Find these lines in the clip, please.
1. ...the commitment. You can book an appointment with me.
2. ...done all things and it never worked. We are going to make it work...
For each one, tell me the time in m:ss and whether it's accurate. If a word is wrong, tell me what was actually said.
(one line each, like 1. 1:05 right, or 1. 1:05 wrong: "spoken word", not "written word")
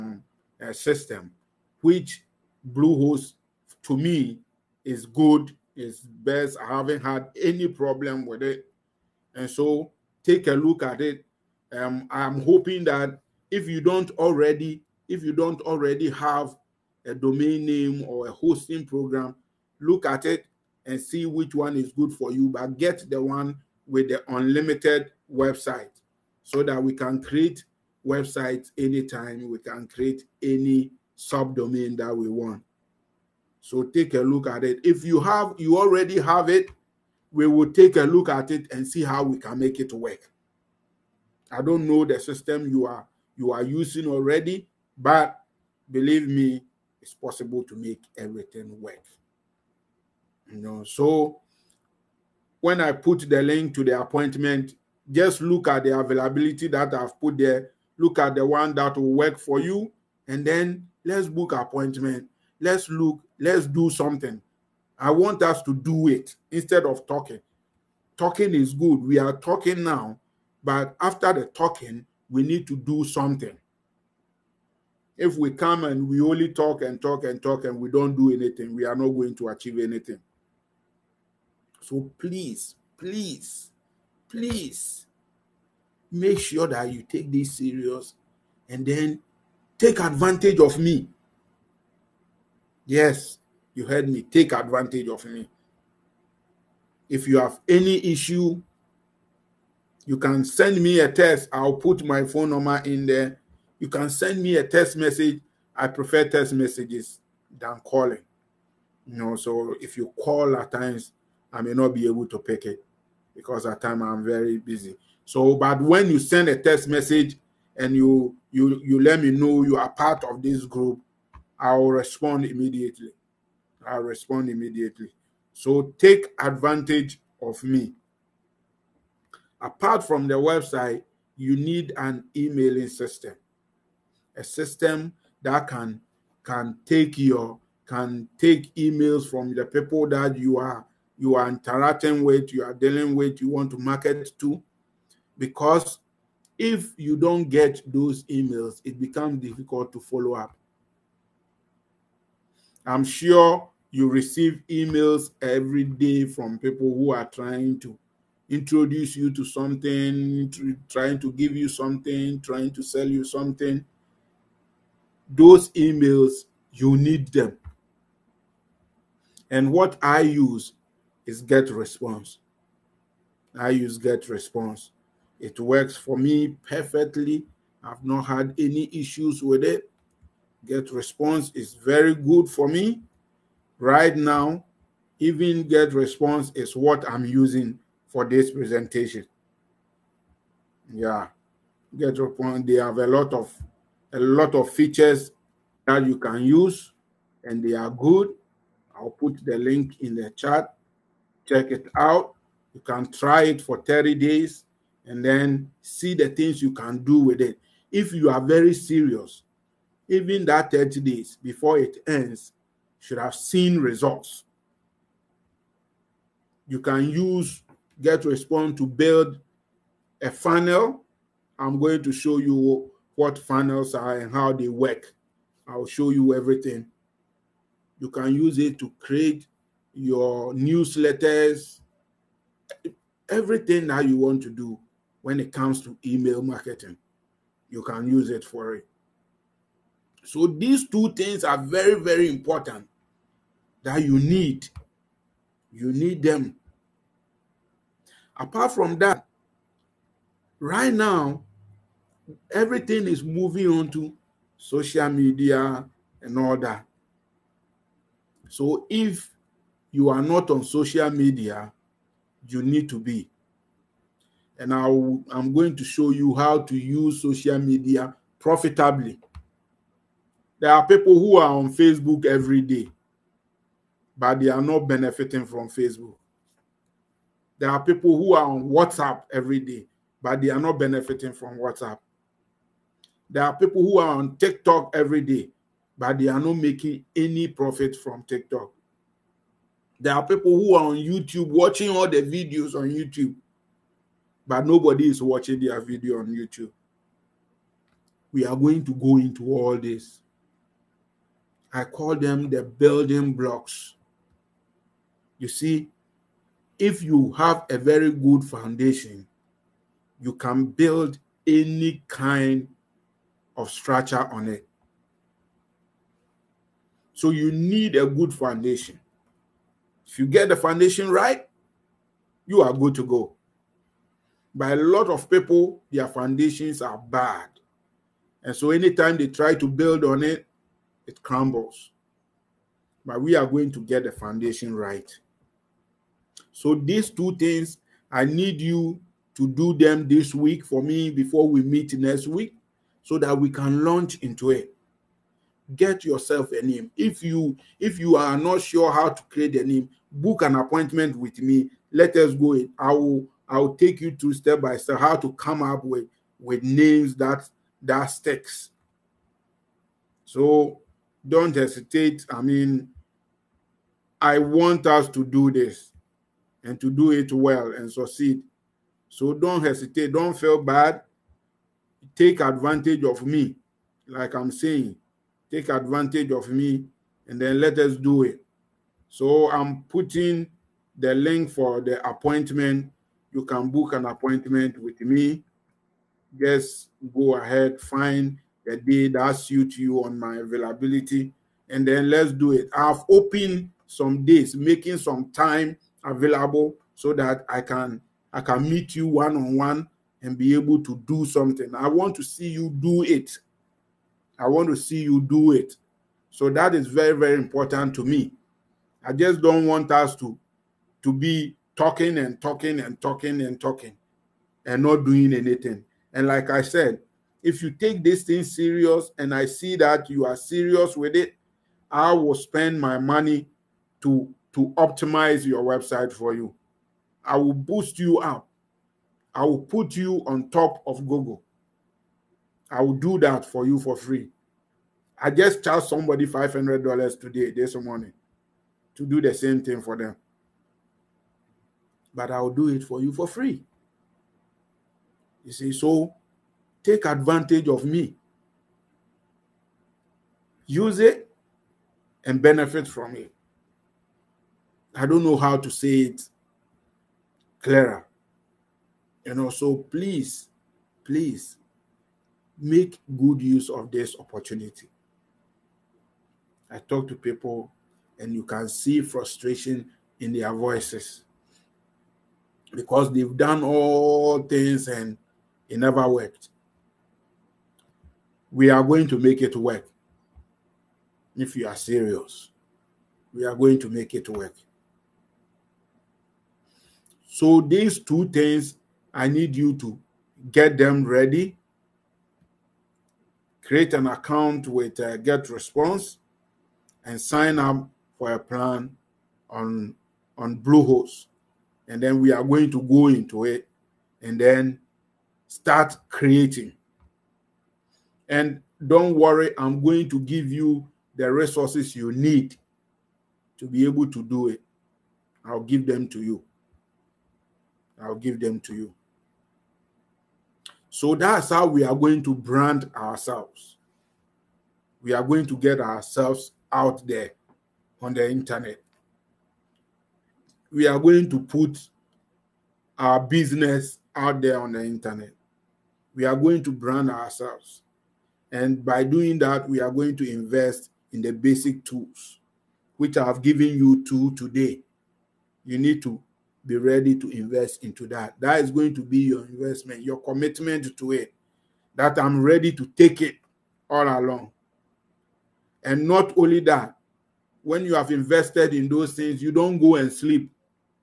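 1. 6:21 wrong: "appointment", not "commitment"
2. 7:53 right.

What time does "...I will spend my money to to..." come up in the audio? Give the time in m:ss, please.
7:01.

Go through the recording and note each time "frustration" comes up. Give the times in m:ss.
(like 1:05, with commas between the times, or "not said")
7:49.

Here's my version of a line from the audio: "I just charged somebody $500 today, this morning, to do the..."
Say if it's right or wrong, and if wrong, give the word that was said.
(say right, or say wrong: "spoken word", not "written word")
right.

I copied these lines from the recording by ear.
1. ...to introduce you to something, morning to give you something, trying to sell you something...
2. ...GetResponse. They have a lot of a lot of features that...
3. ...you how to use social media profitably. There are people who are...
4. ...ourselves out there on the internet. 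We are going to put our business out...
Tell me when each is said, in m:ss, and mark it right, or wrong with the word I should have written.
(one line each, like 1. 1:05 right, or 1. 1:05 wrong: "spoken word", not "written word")
1. 2:37 wrong: "trying", not "morning"
2. 3:11 right
3. 4:26 right
4. 8:45 right.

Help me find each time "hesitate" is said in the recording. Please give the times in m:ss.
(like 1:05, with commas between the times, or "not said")
6:01, 6:09.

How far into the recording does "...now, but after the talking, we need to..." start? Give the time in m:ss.
1:09.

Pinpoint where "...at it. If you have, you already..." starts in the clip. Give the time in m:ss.
0:34.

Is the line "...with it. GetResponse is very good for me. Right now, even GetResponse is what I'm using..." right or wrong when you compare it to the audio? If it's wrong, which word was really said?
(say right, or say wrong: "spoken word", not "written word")
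right.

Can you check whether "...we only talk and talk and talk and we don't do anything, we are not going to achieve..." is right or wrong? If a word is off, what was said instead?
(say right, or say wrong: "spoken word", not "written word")
right.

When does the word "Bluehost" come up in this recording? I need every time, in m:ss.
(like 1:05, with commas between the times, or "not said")
0:02, 8:20.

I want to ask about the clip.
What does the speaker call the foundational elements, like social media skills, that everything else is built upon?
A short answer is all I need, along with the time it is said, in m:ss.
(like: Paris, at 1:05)
the building blocks, at 5:02.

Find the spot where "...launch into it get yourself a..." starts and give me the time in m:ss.
5:43.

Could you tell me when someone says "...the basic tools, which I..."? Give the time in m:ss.
9:01.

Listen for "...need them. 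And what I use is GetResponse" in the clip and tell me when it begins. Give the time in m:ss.
2:46.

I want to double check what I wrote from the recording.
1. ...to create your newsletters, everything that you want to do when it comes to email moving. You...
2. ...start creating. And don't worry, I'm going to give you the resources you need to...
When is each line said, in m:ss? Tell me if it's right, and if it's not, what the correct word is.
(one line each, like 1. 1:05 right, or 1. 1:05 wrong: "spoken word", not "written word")
1. 3:48 wrong: "marketing", not "moving"
2. 8:25 right.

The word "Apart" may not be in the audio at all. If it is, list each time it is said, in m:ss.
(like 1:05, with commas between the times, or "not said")
2:09, 4:08.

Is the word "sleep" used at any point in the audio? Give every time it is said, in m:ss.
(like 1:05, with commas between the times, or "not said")
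9:20.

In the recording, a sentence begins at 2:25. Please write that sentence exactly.
Because if you don't get those emails, it becomes difficult to follow up.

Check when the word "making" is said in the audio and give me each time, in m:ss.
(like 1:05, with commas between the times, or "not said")
4:46, 6:34.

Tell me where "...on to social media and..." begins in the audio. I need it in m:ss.
4:13.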